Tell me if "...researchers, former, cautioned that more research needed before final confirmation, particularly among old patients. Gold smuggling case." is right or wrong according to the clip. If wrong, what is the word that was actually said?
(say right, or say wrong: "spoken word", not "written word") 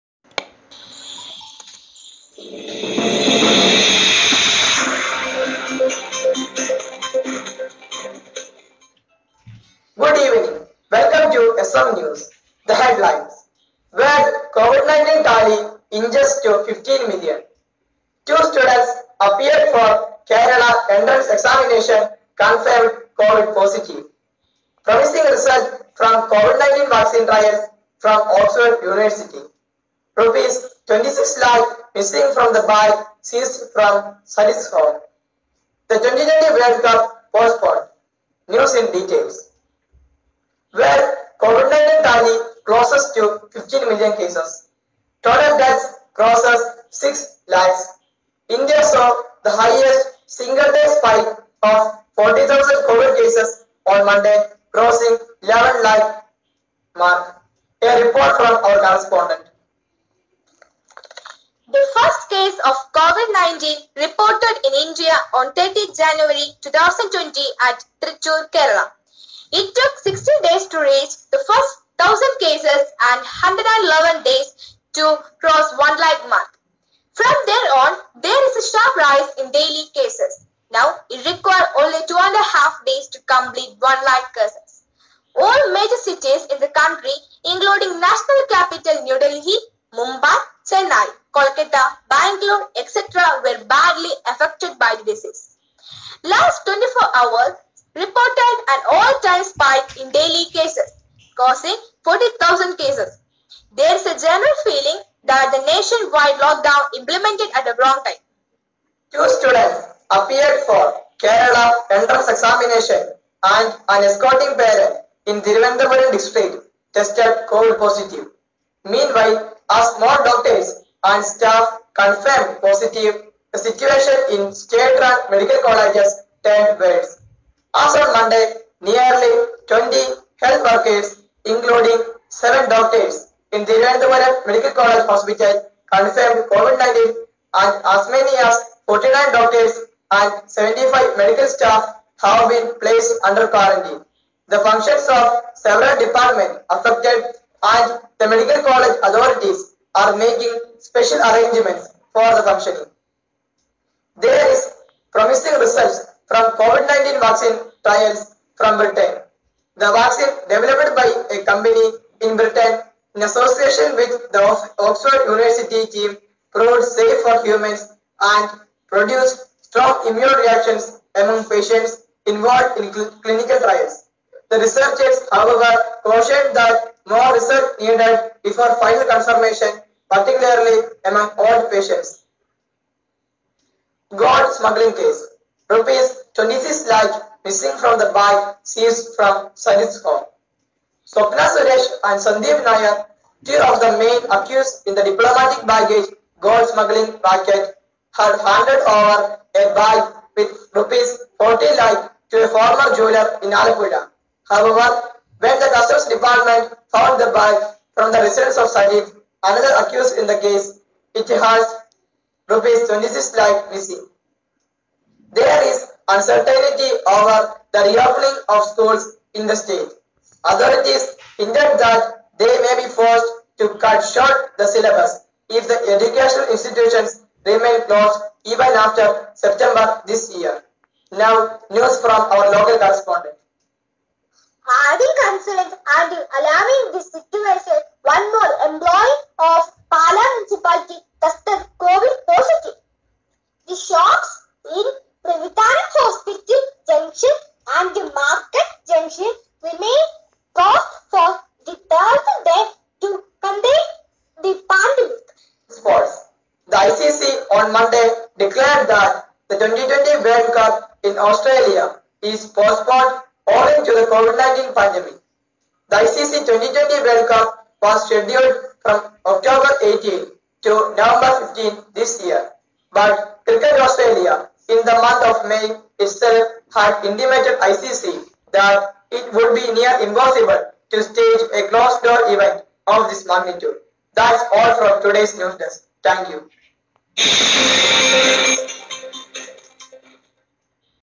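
wrong: "however", not "former".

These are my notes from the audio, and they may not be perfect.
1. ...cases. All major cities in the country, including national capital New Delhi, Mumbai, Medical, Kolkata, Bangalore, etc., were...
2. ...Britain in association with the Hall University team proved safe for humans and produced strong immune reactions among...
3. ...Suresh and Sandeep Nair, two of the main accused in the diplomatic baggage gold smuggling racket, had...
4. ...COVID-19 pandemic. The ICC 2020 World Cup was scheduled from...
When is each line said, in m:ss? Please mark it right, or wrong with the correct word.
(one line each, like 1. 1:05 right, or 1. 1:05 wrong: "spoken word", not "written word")
1. 1:24 wrong: "Chennai", not "Medical"
2. 2:42 wrong: "Oxford", not "Hall"
3. 3:11 right
4. 4:24 right.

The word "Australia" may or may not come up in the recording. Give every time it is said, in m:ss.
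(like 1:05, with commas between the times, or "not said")
4:21, 4:33.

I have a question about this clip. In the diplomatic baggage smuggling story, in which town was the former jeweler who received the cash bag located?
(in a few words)
Alappuzha.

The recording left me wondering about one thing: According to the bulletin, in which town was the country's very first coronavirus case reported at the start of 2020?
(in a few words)
Trichur.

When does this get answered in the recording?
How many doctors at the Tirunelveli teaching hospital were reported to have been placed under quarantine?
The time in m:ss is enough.
2:18.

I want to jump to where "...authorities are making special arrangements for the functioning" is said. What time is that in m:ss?
2:29.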